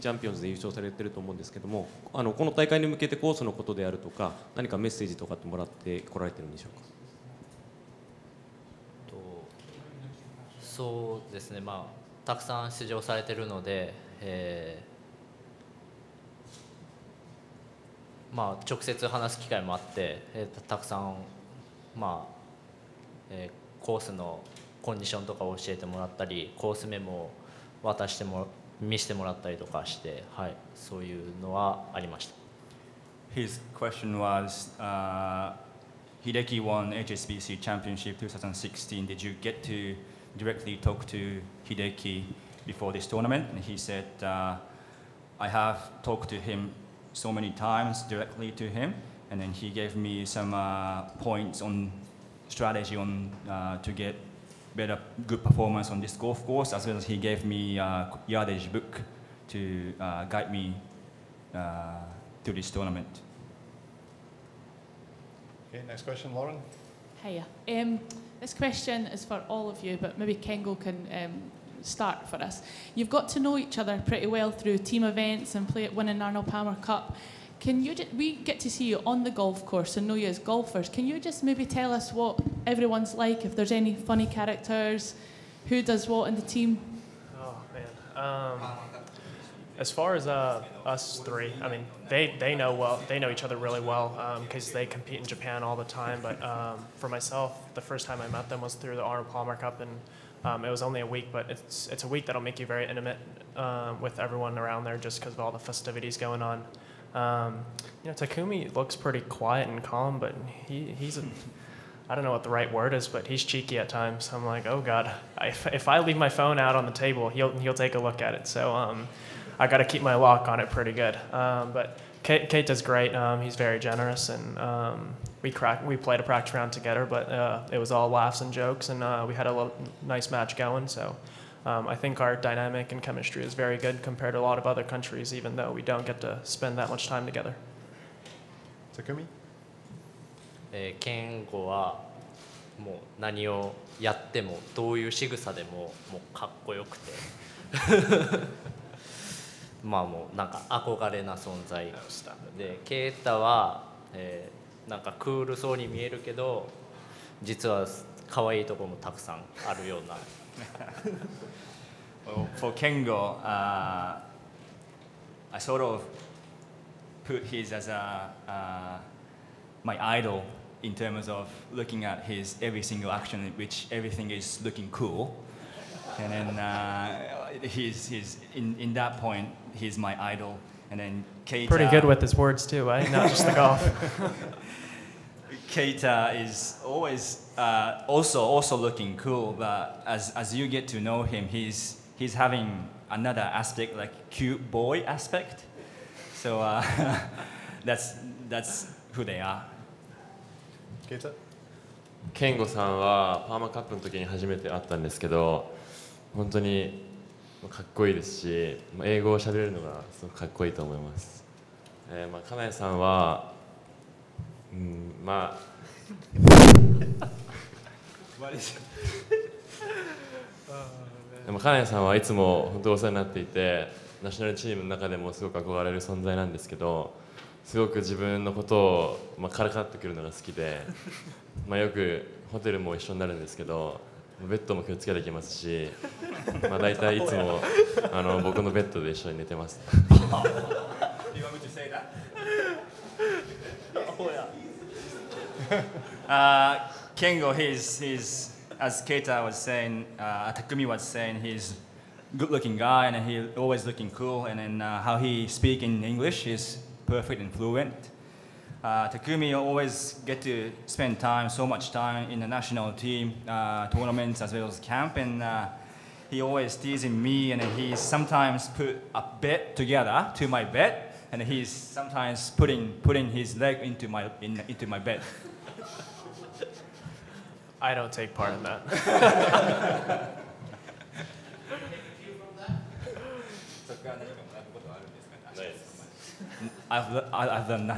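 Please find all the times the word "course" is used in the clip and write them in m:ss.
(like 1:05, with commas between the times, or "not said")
0:56, 1:19.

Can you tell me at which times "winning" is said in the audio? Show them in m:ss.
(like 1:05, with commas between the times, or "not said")
1:15.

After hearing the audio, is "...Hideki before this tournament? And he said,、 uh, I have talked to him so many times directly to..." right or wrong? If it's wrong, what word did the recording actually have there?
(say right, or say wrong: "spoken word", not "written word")
right.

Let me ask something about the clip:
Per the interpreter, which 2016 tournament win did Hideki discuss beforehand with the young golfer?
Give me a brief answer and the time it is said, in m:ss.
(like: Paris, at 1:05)
HSBC Championship, at 0:37.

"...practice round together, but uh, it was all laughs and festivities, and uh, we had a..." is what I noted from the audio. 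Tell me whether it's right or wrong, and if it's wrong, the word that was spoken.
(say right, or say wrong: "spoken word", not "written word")
wrong: "jokes", not "festivities".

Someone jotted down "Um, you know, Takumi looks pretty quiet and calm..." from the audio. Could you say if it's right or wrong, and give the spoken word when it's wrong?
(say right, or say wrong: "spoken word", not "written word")
right.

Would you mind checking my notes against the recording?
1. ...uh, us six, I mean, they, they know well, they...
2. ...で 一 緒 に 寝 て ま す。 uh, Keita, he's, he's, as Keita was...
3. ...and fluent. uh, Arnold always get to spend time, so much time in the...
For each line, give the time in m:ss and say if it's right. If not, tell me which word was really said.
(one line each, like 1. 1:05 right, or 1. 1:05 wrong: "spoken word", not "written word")
1. 1:30 wrong: "three", not "six"
2. 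3:59 wrong: "Kengo", not "Keita"
3. 4:17 wrong: "Takumi", not "Arnold".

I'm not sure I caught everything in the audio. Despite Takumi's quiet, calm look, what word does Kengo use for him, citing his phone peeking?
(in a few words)
Cheeky.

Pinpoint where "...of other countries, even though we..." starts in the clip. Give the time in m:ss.
2:14.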